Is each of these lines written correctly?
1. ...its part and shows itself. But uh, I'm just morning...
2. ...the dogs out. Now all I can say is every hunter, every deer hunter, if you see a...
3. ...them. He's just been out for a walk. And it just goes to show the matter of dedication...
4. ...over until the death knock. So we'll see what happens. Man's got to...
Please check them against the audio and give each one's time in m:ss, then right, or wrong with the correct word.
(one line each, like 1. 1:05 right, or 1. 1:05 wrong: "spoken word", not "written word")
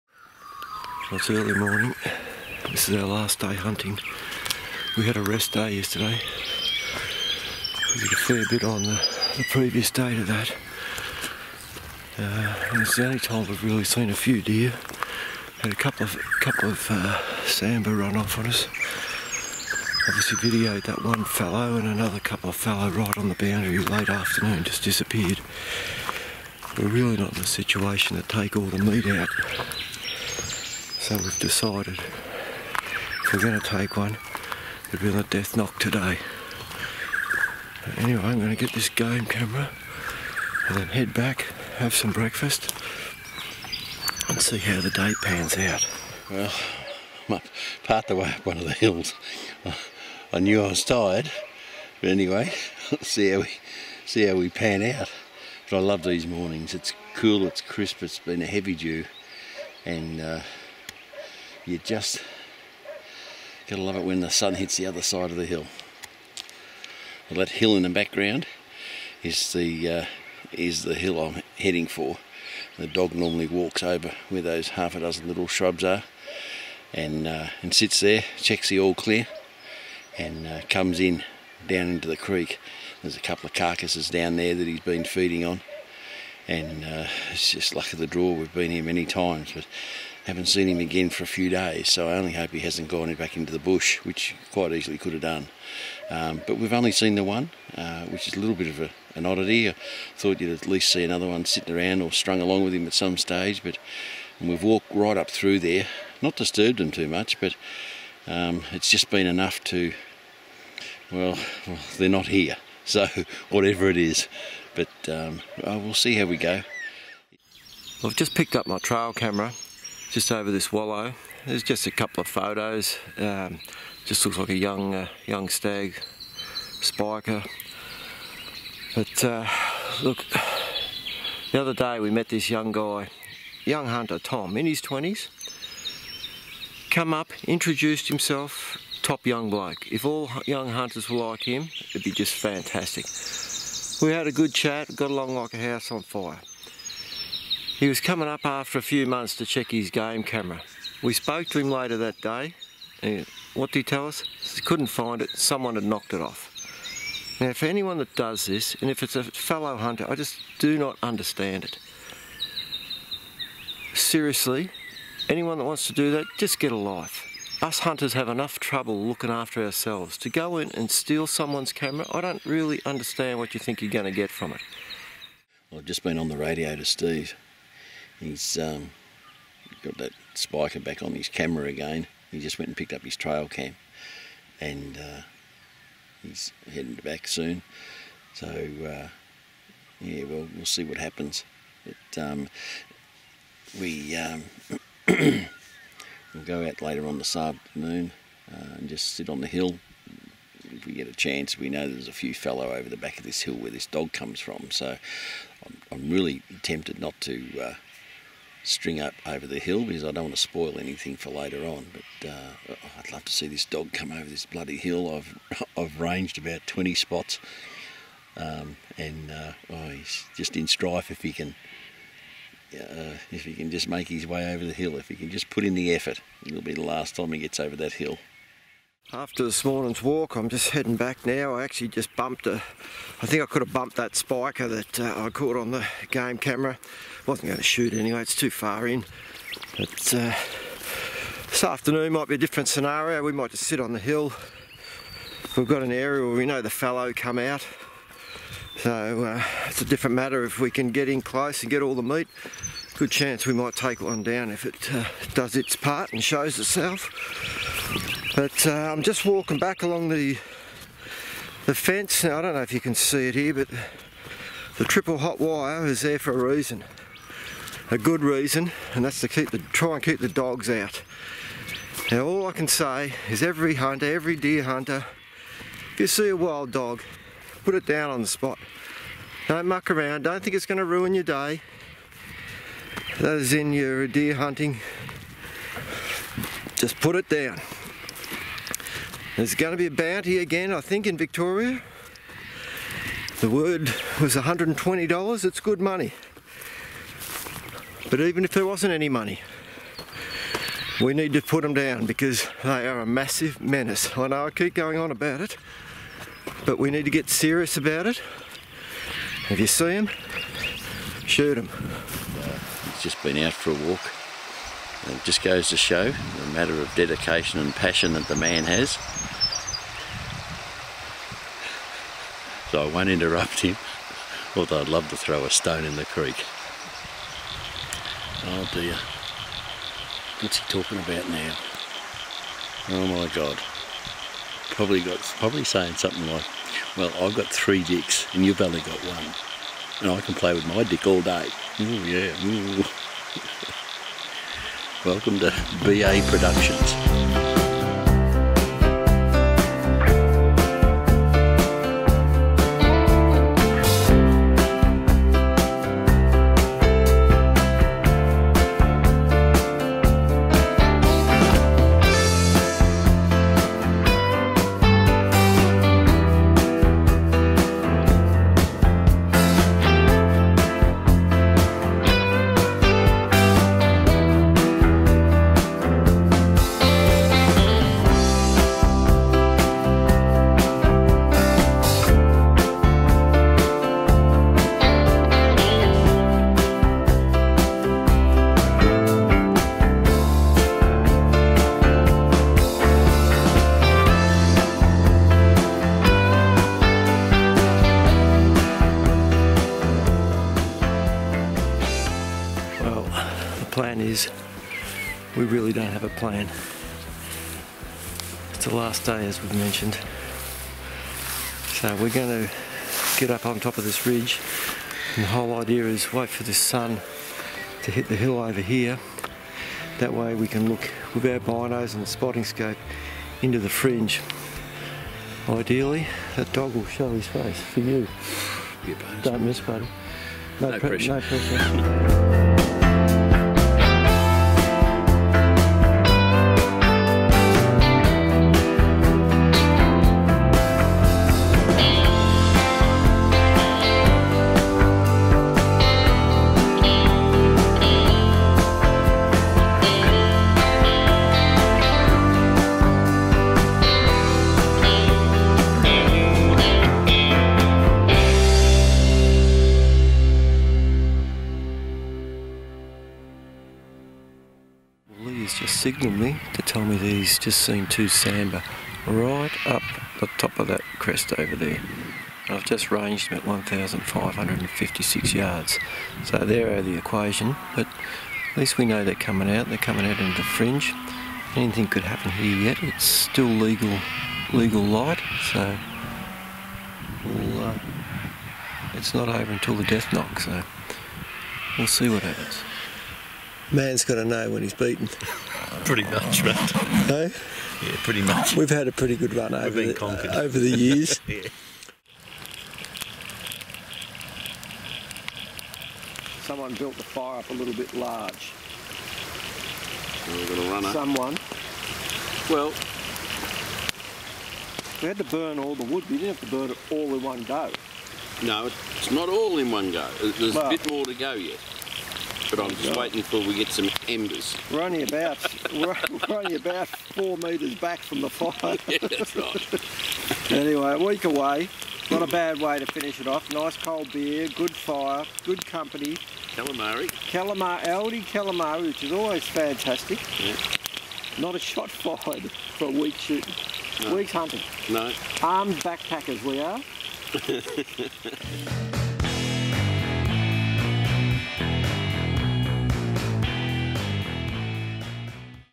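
1. 4:15 wrong: "walking", not "morning"
2. 4:30 right
3. 5:11 right
4. 8:09 right.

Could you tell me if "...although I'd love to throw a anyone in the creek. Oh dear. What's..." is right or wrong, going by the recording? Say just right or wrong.
wrong.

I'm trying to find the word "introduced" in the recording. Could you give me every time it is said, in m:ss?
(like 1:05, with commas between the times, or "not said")
2:17.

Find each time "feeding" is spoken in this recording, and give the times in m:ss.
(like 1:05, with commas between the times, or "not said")
1:25.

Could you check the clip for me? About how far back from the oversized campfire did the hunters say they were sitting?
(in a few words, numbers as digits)
four metres.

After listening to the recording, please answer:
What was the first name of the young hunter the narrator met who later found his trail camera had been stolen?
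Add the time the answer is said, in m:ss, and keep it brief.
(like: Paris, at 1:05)
Tom, at 2:14.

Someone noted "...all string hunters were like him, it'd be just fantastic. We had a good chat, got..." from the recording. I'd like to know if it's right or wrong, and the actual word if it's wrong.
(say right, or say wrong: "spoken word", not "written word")
wrong: "young", not "string".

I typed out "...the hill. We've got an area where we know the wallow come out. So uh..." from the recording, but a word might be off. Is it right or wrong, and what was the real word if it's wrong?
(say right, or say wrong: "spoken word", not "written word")
wrong: "fallow", not "wallow".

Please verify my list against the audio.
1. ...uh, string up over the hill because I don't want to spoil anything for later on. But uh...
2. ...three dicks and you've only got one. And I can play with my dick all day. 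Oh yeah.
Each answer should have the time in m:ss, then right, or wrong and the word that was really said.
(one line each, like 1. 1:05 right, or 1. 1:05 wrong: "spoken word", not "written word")
1. 3:27 right
2. 5:37 right.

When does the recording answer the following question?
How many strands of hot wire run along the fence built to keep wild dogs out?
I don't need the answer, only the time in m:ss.
4:24.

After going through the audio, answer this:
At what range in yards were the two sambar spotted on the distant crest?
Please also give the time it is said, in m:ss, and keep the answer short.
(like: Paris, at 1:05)
1,556 yards, at 7:53.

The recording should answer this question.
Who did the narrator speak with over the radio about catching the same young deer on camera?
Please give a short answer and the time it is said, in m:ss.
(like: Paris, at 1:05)
Steve, at 2:56.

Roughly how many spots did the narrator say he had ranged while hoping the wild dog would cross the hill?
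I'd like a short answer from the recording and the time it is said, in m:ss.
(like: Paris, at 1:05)
20, at 3:36.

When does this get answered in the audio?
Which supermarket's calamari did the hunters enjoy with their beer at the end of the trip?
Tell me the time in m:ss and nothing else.
8:57.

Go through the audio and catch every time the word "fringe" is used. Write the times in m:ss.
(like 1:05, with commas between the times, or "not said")
7:03, 8:00.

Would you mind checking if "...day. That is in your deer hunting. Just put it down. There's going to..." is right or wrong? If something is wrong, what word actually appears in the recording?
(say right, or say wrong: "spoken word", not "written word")
right.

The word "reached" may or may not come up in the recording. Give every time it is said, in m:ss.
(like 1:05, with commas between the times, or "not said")
not said.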